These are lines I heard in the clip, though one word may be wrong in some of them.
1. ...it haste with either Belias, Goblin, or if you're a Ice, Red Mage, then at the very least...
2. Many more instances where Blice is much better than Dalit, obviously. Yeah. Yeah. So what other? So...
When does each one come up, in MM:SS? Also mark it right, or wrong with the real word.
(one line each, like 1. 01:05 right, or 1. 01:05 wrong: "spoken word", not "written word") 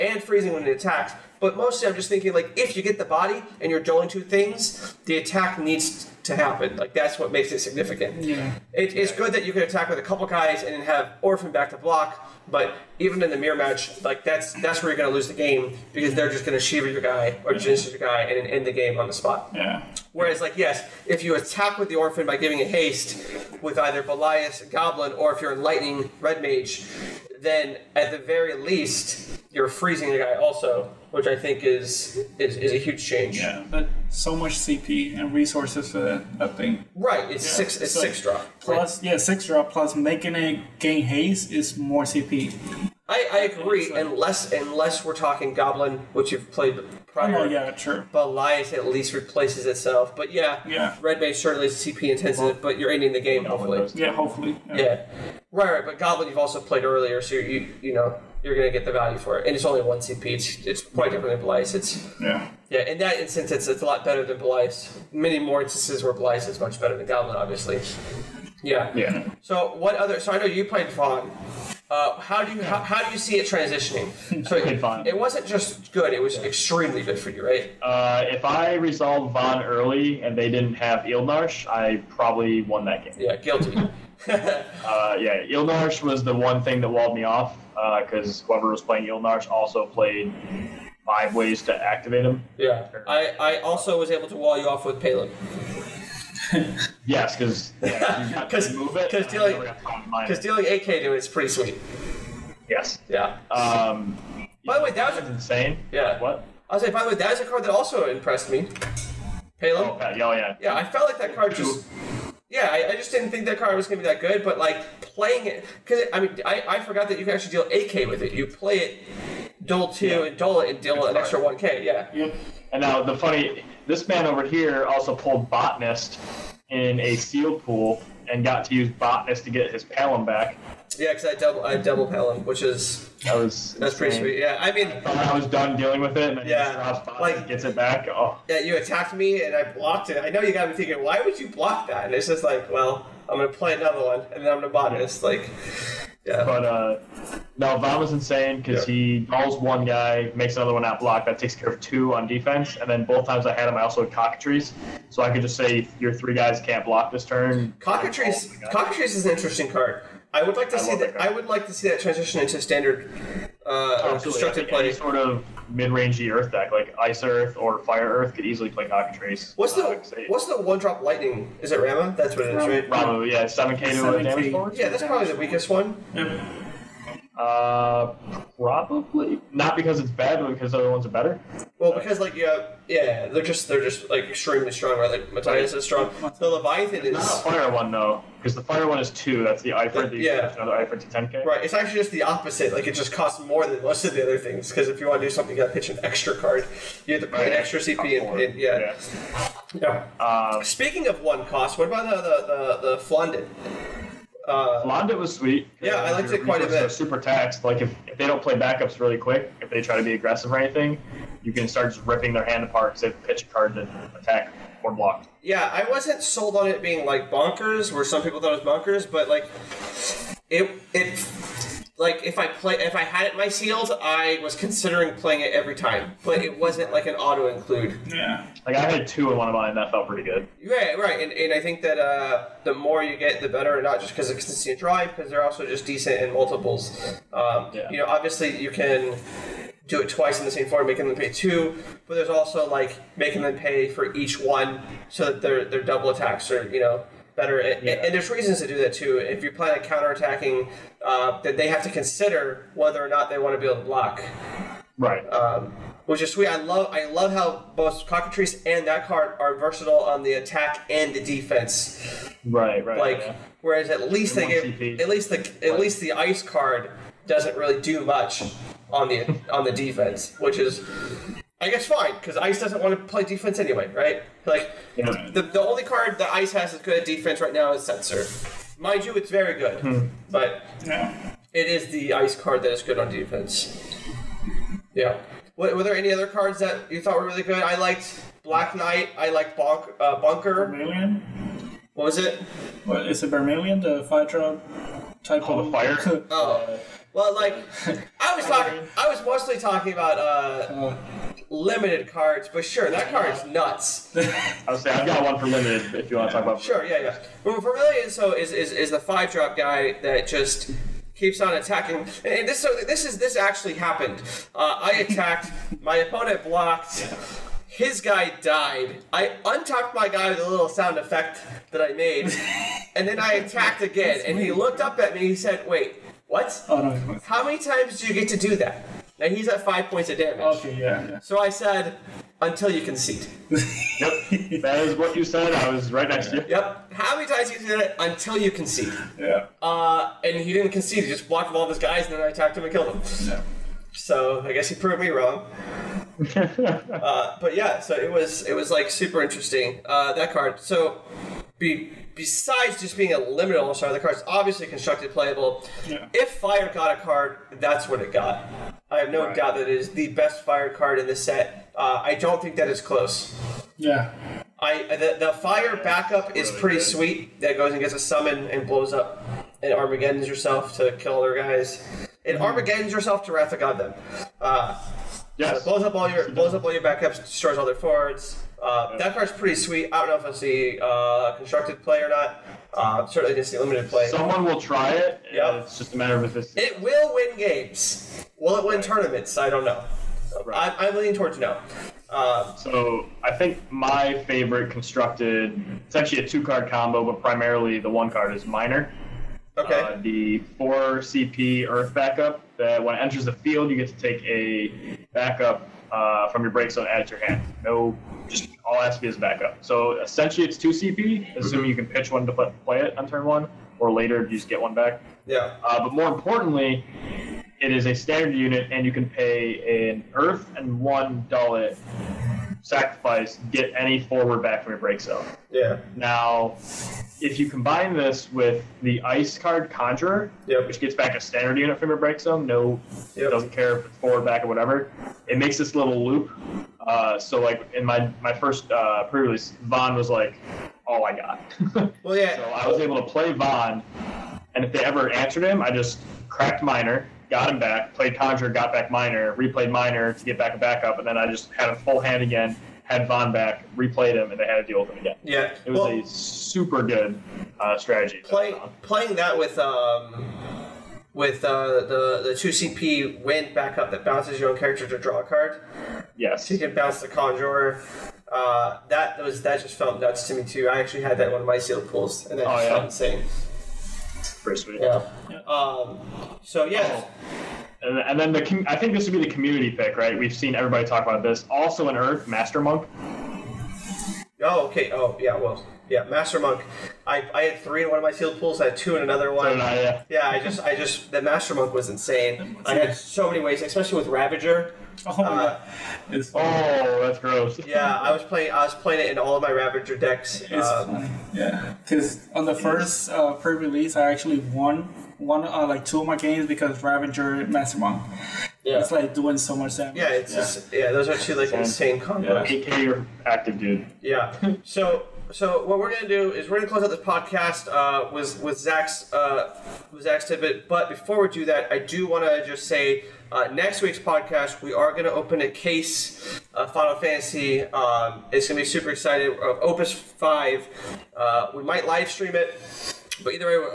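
1. 00:22 wrong: "Lightning", not "Ice"
2. 01:05 wrong: "Goblin", not "Dalit".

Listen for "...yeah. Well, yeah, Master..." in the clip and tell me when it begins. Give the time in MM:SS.
08:05.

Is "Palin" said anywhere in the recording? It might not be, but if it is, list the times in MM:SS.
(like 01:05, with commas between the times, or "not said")
01:35, 01:49.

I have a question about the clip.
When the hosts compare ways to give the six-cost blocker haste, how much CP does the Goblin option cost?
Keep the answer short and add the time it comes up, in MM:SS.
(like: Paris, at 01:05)
1 CP, at 00:59.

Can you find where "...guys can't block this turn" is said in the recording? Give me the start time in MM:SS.
02:36.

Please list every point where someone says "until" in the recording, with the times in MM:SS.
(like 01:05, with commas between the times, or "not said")
05:32, 05:37.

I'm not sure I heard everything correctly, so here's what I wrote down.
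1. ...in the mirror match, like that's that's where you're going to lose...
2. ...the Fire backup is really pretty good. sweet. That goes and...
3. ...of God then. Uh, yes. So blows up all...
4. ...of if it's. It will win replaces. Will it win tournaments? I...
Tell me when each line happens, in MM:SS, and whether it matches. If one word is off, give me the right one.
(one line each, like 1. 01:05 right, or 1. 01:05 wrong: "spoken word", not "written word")
1. 00:13 right
2. 06:05 right
3. 06:13 right
4. 06:26 wrong: "games", not "replaces".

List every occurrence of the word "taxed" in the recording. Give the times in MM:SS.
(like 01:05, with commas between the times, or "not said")
03:27.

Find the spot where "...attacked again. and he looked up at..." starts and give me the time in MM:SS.
05:23.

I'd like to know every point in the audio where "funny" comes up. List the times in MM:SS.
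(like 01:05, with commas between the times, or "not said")
02:03, 08:20.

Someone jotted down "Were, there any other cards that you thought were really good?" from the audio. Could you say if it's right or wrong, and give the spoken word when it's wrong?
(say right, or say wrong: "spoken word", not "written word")
right.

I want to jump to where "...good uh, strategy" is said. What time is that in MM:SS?
07:36.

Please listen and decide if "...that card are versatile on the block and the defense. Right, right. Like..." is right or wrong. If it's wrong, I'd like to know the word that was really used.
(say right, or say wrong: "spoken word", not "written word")
wrong: "attack", not "block".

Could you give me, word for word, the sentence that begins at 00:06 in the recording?
Like that's what makes it significant.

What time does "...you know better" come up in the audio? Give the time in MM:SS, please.
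04:06.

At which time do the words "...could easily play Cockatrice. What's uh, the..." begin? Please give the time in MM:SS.
02:48.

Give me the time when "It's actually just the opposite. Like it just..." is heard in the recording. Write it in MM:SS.
03:11.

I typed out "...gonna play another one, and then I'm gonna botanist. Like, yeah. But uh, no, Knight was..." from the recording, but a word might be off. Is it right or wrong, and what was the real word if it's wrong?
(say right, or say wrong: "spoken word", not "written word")
wrong: "Von", not "Knight".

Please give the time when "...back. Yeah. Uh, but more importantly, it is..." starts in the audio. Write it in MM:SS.
06:54.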